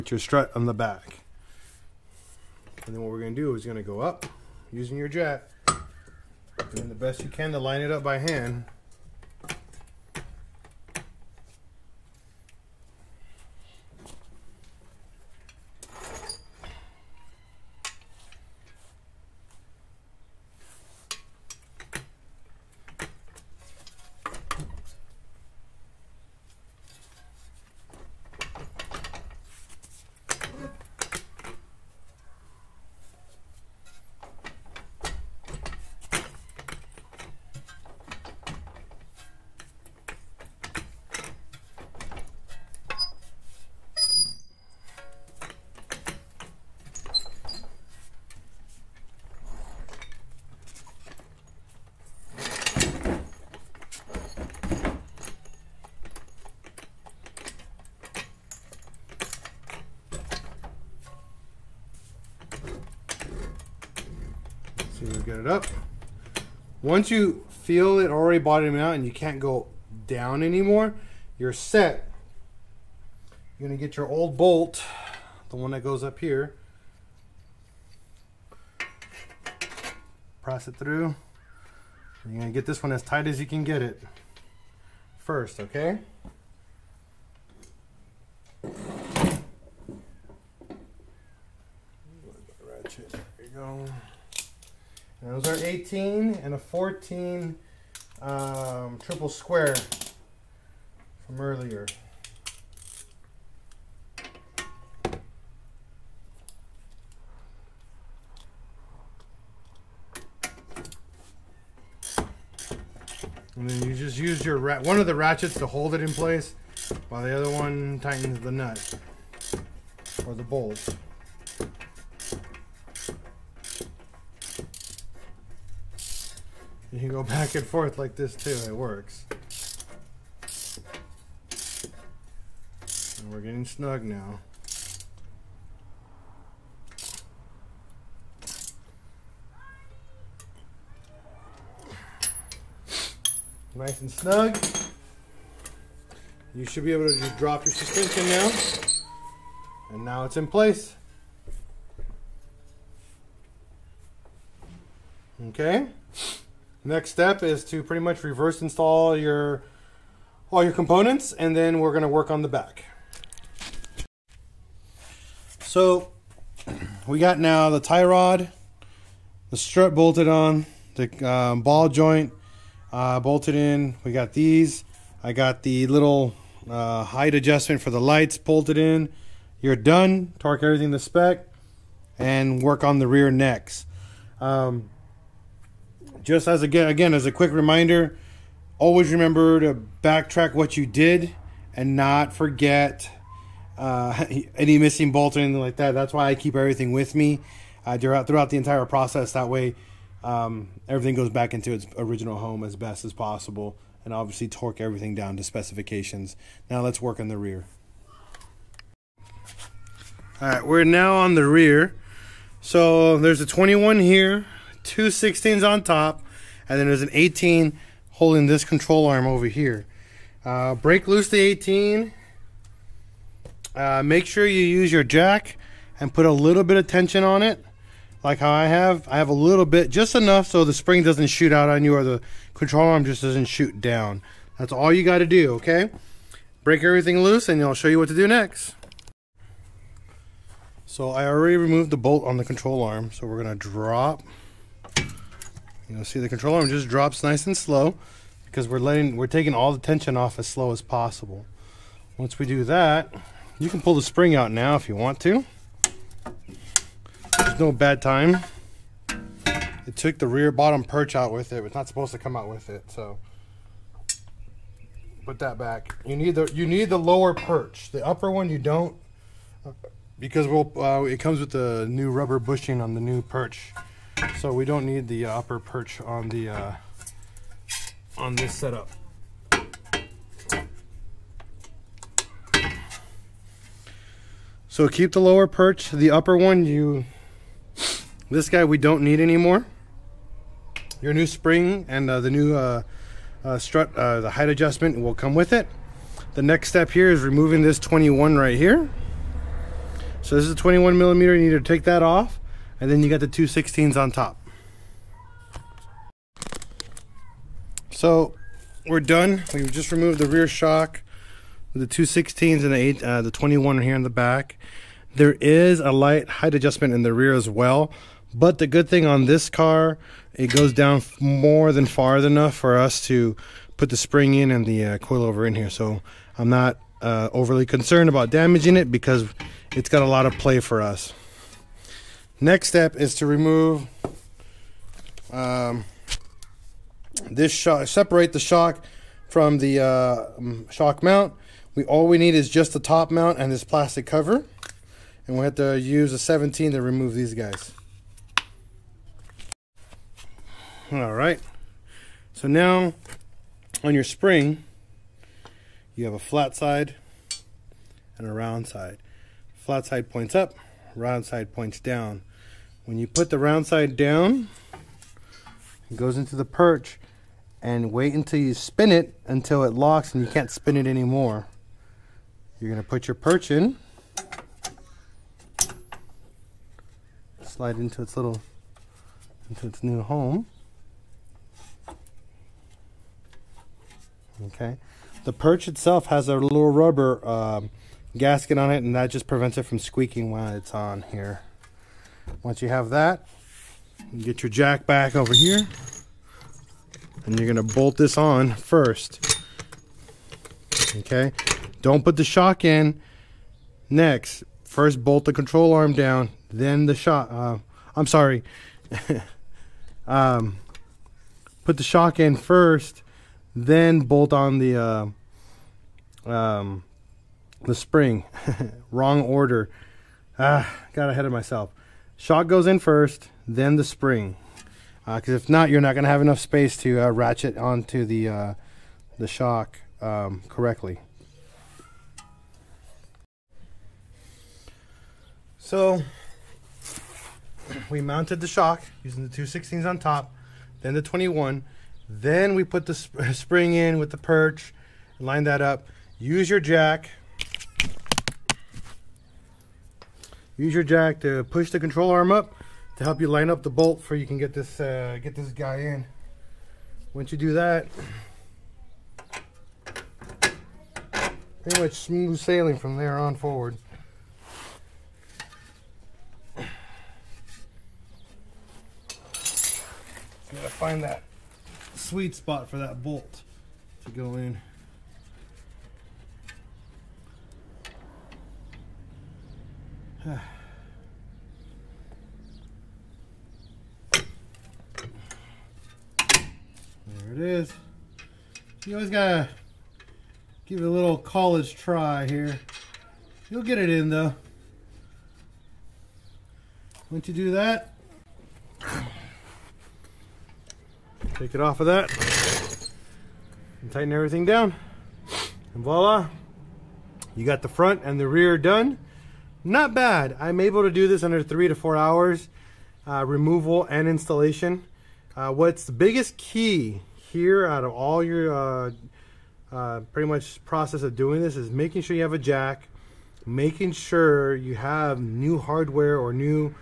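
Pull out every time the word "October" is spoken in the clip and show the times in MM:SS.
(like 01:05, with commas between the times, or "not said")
not said.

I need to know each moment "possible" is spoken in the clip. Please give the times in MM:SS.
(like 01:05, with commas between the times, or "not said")
03:23, 04:10.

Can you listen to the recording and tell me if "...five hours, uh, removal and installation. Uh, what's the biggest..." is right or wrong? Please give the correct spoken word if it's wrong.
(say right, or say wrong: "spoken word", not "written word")
wrong: "four", not "five".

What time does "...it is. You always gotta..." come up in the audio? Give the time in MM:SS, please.
08:07.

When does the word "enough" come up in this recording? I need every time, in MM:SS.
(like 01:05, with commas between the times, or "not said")
03:50, 05:22, 07:06.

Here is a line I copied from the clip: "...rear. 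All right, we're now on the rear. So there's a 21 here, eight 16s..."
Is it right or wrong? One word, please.
wrong.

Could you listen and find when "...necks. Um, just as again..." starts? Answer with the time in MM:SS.
03:03.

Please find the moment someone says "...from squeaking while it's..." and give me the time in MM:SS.
06:29.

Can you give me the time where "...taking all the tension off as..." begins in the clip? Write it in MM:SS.
04:09.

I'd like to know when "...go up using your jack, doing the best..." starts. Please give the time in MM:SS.
00:03.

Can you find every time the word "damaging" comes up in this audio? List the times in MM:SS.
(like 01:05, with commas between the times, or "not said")
05:28.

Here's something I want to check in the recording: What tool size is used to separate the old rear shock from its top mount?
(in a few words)
17.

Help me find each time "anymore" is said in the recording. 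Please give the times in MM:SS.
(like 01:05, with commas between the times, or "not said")
01:10, 04:49, 06:10.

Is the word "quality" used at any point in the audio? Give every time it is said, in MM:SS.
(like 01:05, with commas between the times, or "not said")
not said.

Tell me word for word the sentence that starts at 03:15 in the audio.
That's why I keep everything with me uh, throughout throughout the entire process.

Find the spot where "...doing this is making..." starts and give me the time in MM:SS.
08:41.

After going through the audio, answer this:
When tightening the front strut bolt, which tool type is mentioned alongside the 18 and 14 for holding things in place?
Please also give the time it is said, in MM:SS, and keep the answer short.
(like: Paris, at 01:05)
triple square, at 01:38.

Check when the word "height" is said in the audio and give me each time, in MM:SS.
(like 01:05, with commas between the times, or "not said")
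02:57, 04:54, 05:16.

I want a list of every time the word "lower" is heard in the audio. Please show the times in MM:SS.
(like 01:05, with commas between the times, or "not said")
04:26, 04:45.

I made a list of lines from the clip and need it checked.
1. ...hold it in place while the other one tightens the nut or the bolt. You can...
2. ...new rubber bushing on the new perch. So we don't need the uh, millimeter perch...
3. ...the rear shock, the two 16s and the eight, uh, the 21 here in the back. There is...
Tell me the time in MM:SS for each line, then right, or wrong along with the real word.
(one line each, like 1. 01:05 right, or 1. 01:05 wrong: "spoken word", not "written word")
1. 01:55 right
2. 04:31 wrong: "upper", not "millimeter"
3. 05:10 right.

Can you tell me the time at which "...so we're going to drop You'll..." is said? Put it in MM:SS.
04:03.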